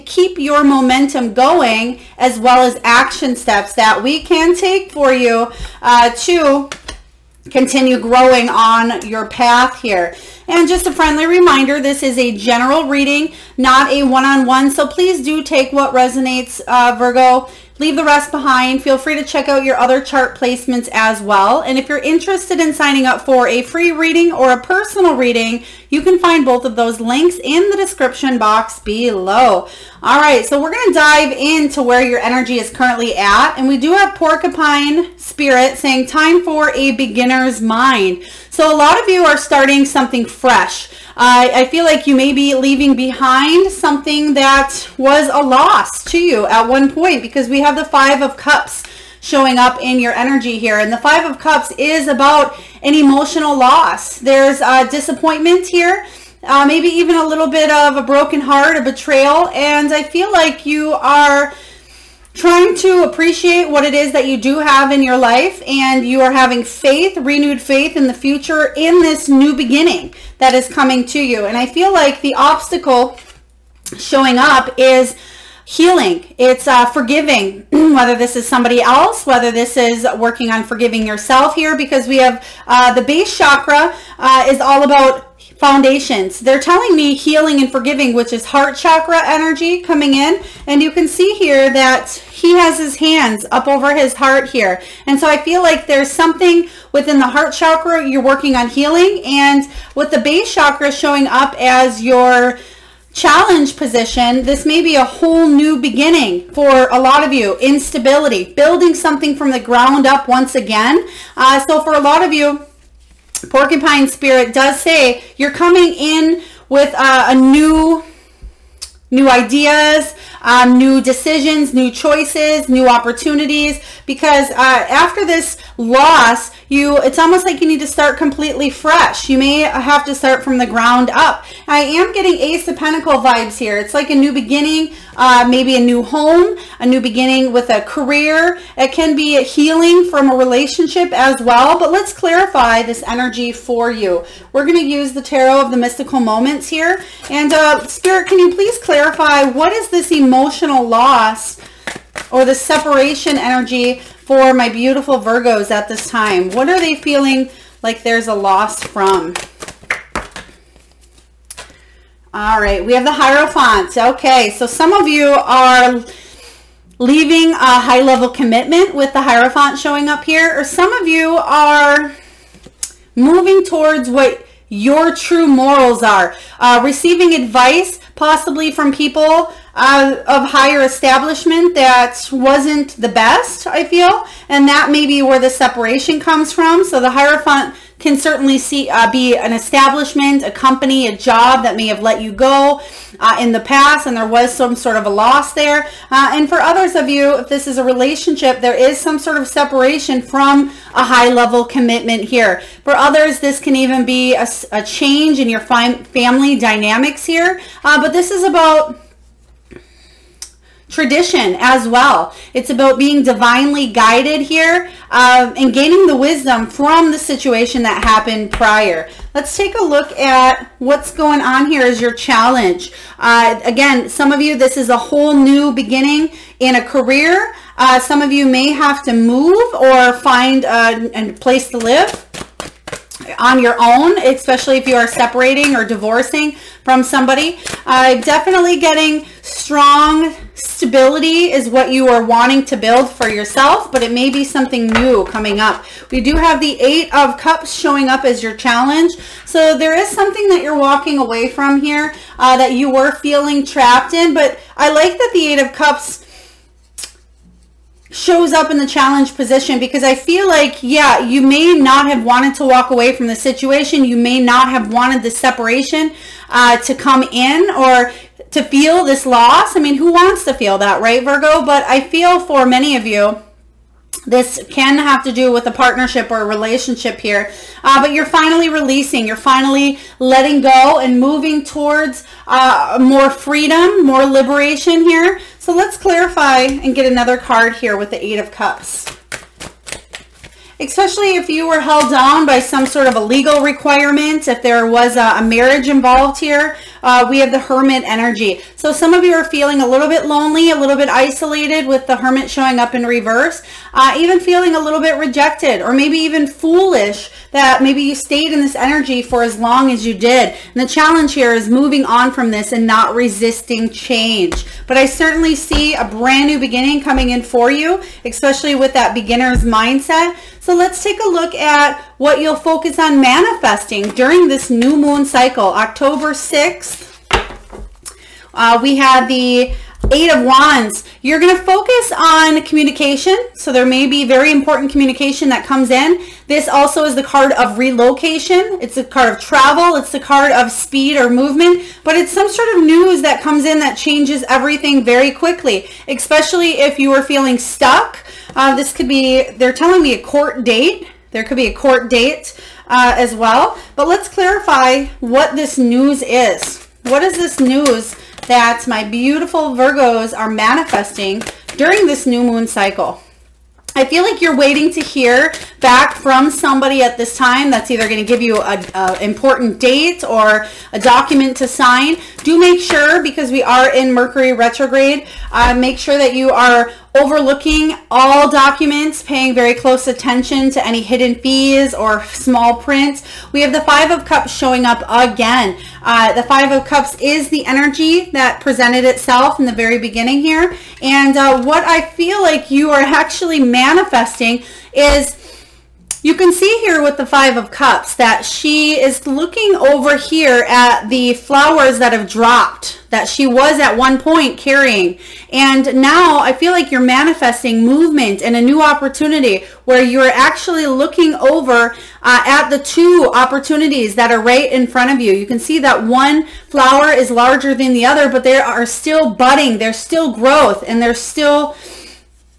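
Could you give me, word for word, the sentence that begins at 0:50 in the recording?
And the Five of Cups is about an emotional loss.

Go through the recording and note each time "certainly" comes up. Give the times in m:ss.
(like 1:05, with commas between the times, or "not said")
3:08, 5:15.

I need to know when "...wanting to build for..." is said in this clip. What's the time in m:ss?
4:02.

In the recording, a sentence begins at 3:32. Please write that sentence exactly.
It's about being divinely guided here um, and gaining the wisdom from the situation that happened prior.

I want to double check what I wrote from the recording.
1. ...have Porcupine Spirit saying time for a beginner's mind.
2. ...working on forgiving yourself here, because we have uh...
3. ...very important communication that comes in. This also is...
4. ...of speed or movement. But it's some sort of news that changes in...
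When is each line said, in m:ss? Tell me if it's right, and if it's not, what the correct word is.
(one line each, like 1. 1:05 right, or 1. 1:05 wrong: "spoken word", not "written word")
1. 0:33 right
2. 1:20 right
3. 5:34 right
4. 5:40 wrong: "comes", not "changes".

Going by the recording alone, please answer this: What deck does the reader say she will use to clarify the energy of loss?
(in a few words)
tarot of the mystical moments.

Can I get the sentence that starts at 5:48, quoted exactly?
Uh, this could be, they're telling me a court date.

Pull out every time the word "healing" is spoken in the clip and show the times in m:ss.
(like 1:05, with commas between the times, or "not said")
1:15, 1:27, 1:38, 2:19.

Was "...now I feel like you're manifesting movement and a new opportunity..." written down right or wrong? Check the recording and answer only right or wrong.
right.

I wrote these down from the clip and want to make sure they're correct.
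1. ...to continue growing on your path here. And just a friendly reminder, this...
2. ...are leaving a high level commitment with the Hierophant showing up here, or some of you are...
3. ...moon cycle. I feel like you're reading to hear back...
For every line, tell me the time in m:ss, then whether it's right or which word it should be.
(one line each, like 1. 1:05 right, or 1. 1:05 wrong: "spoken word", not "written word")
1. 0:06 right
2. 2:45 right
3. 6:02 wrong: "waiting", not "reading".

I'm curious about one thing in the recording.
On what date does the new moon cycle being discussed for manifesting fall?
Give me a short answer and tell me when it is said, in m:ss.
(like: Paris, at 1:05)
October 6th, at 5:25.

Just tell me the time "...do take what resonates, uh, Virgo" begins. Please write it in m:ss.
0:15.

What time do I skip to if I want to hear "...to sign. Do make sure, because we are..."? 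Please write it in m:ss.
6:11.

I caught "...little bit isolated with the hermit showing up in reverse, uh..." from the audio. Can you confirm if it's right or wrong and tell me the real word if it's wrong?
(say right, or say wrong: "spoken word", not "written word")
right.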